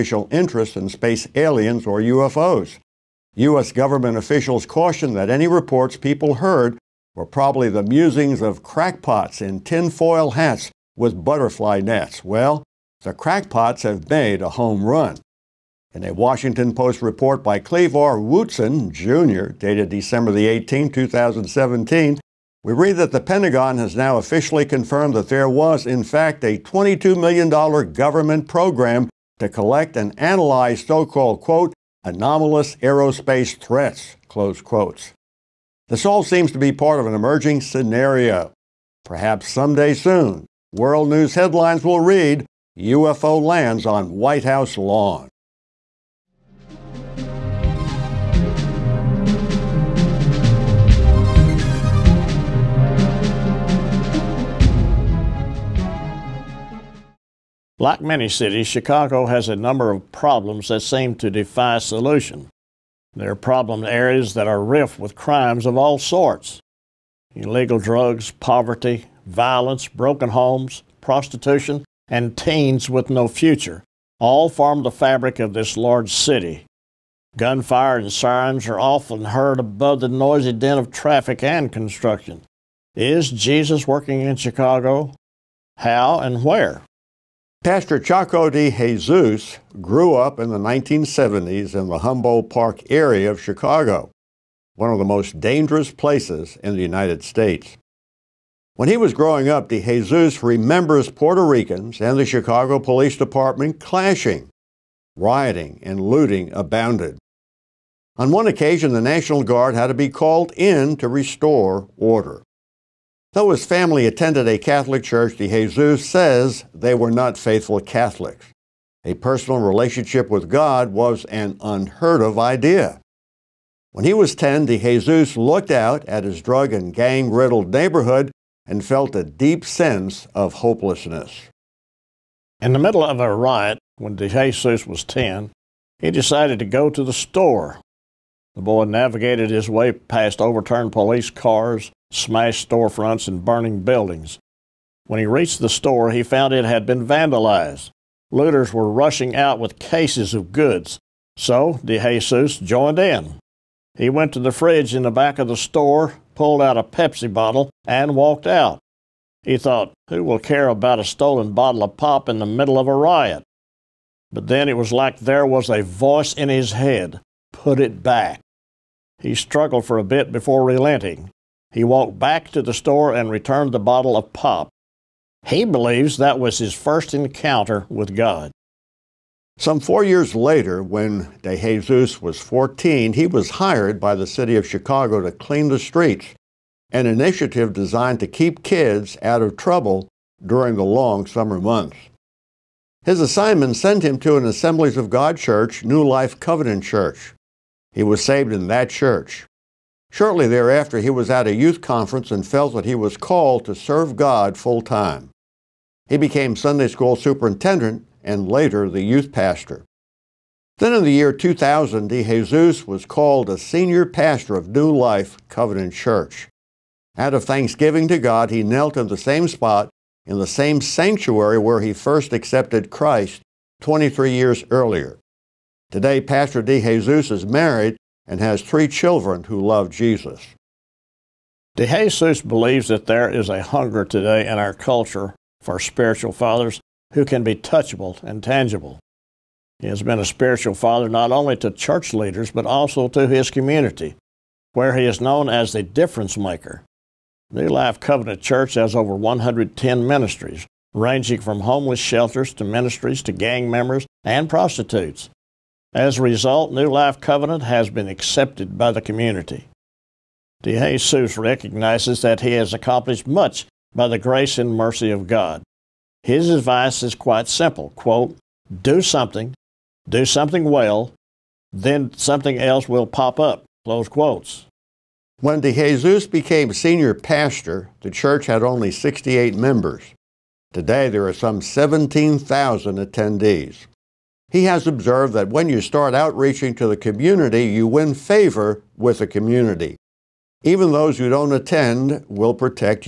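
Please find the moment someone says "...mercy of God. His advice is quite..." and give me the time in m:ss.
4:24.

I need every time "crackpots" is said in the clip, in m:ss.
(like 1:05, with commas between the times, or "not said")
0:08, 0:13.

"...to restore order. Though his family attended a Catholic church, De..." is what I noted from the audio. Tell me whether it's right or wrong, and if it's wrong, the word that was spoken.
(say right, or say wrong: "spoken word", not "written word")
right.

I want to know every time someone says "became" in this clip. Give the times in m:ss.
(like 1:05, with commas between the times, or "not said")
3:26, 4:36.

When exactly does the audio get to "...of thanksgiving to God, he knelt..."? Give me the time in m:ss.
3:37.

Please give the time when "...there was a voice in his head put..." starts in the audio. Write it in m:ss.
2:45.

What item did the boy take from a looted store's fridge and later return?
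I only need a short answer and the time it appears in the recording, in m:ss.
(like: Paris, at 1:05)
A Pepsi bottle, at 2:36.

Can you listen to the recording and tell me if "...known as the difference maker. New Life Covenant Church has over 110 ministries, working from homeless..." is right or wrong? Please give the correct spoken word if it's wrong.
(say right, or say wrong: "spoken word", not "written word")
wrong: "ranging", not "working".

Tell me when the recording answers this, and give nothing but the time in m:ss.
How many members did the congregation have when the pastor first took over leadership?
4:38.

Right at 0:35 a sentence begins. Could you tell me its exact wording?
This all seems to be part of an emerging scenario.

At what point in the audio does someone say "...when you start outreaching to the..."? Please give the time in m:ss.
4:45.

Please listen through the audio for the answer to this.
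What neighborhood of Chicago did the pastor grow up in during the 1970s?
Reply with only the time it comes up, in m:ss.
1:31.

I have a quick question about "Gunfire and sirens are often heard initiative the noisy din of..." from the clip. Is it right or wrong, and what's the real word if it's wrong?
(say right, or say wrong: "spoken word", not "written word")
wrong: "above", not "initiative".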